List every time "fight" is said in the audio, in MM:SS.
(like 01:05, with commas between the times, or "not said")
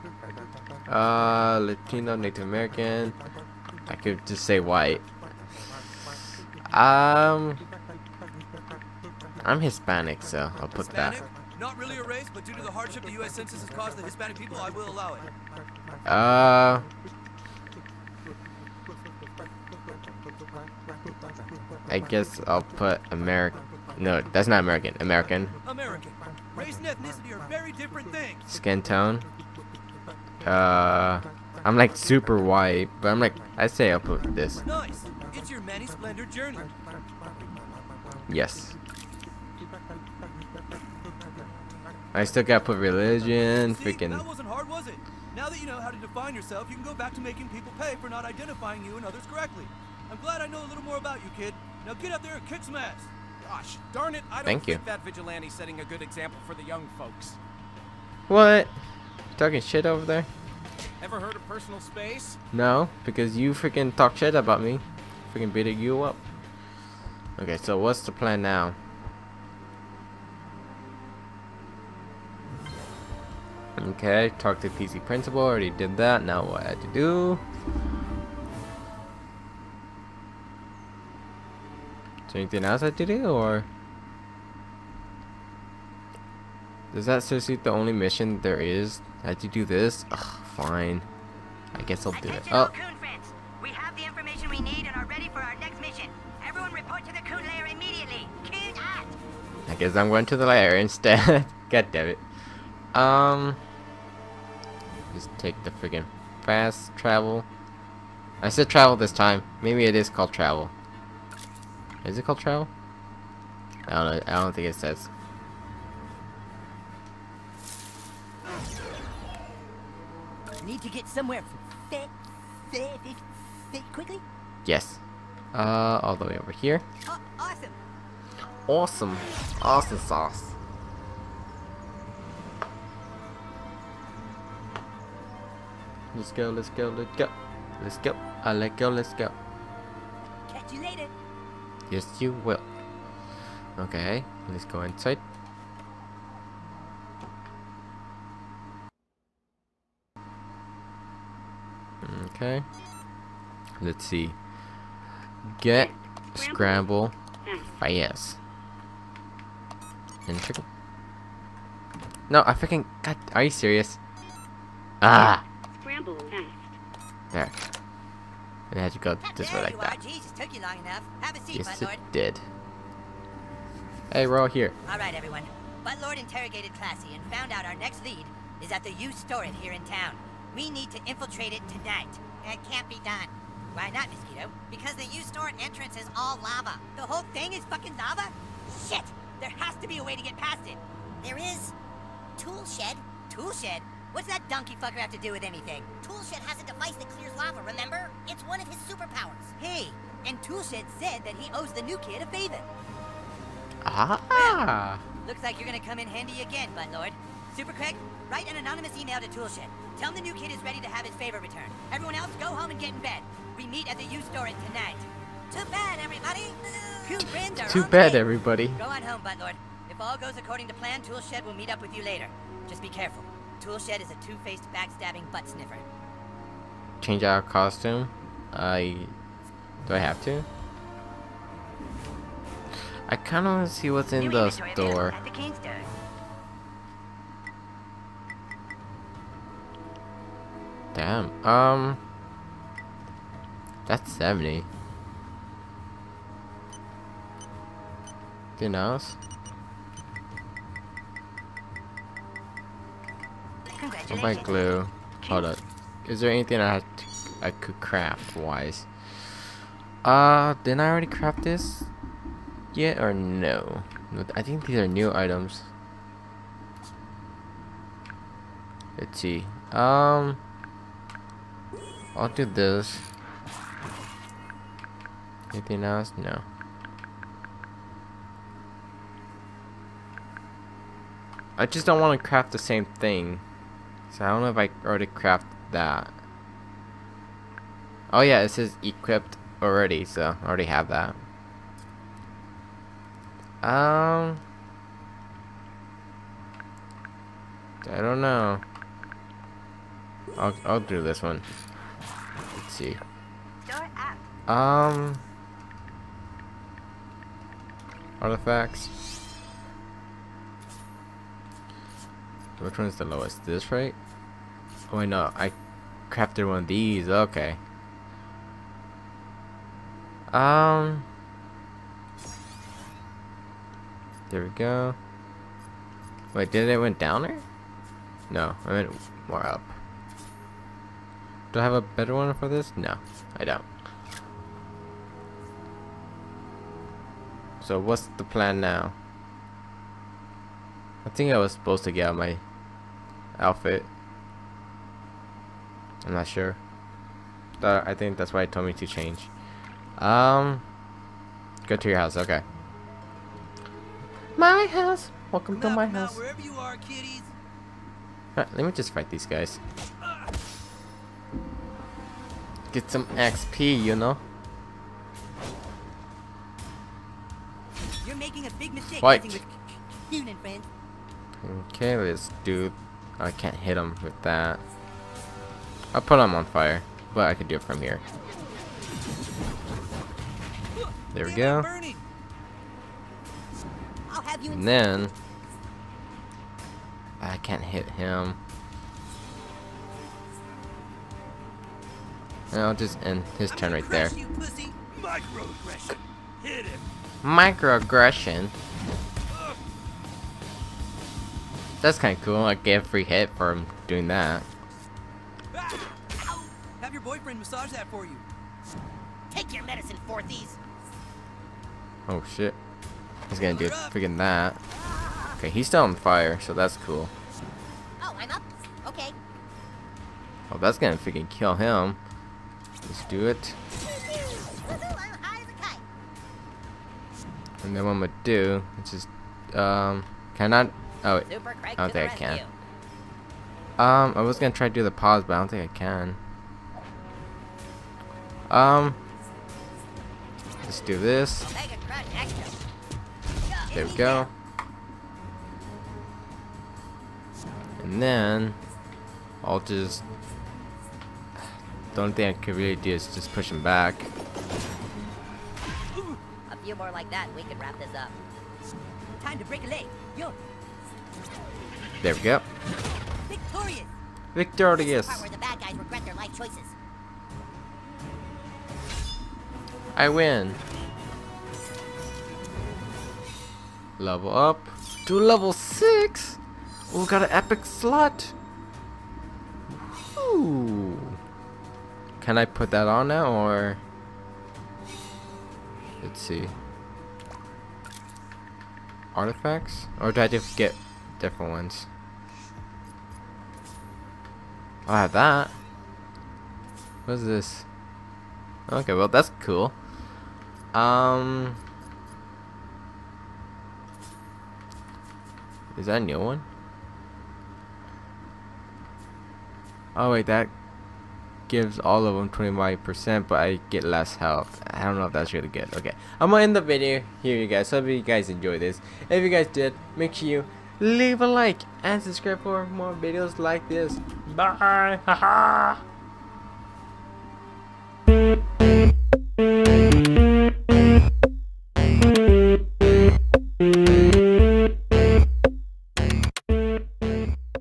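05:58, 06:08.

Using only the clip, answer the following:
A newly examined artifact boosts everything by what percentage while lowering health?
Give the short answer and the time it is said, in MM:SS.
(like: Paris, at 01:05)
25%, at 08:32.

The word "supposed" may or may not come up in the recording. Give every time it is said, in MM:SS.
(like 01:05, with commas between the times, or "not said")
05:41.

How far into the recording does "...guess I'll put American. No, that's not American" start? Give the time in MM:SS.
00:21.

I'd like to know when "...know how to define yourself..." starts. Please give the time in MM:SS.
00:45.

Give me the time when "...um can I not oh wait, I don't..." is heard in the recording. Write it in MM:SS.
07:09.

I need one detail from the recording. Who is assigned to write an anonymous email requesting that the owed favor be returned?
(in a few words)
Super Craig.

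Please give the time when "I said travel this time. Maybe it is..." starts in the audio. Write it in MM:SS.
01:48.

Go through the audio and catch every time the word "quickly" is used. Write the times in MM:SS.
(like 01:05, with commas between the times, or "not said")
02:03.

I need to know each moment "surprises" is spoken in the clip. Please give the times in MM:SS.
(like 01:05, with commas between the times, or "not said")
not said.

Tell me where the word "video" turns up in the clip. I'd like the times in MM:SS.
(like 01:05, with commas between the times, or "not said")
08:36, 08:42.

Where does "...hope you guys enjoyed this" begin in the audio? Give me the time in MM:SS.
08:37.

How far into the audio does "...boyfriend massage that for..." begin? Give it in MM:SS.
06:47.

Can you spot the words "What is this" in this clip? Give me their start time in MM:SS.
08:17.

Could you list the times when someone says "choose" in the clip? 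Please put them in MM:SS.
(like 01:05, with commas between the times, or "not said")
not said.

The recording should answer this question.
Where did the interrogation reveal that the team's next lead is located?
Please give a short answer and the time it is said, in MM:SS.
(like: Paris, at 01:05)
U-Stor-It, at 02:58.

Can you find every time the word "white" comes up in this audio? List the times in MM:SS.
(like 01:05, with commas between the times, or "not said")
00:04, 00:32.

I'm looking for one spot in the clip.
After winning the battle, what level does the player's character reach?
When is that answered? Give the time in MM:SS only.
07:55.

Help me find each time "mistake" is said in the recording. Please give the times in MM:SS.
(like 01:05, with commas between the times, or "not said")
06:08.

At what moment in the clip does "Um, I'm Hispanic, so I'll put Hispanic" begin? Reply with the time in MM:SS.
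00:06.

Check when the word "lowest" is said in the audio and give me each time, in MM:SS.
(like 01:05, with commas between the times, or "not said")
05:13.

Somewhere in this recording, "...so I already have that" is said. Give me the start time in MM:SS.
04:50.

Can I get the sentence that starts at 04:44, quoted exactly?
So I don't know if I already crafted that.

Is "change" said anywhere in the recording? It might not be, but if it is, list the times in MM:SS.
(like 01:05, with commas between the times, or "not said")
03:47, 05:48.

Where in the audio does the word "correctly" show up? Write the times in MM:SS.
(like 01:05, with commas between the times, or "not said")
00:49.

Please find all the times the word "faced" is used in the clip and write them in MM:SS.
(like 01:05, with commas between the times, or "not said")
03:44.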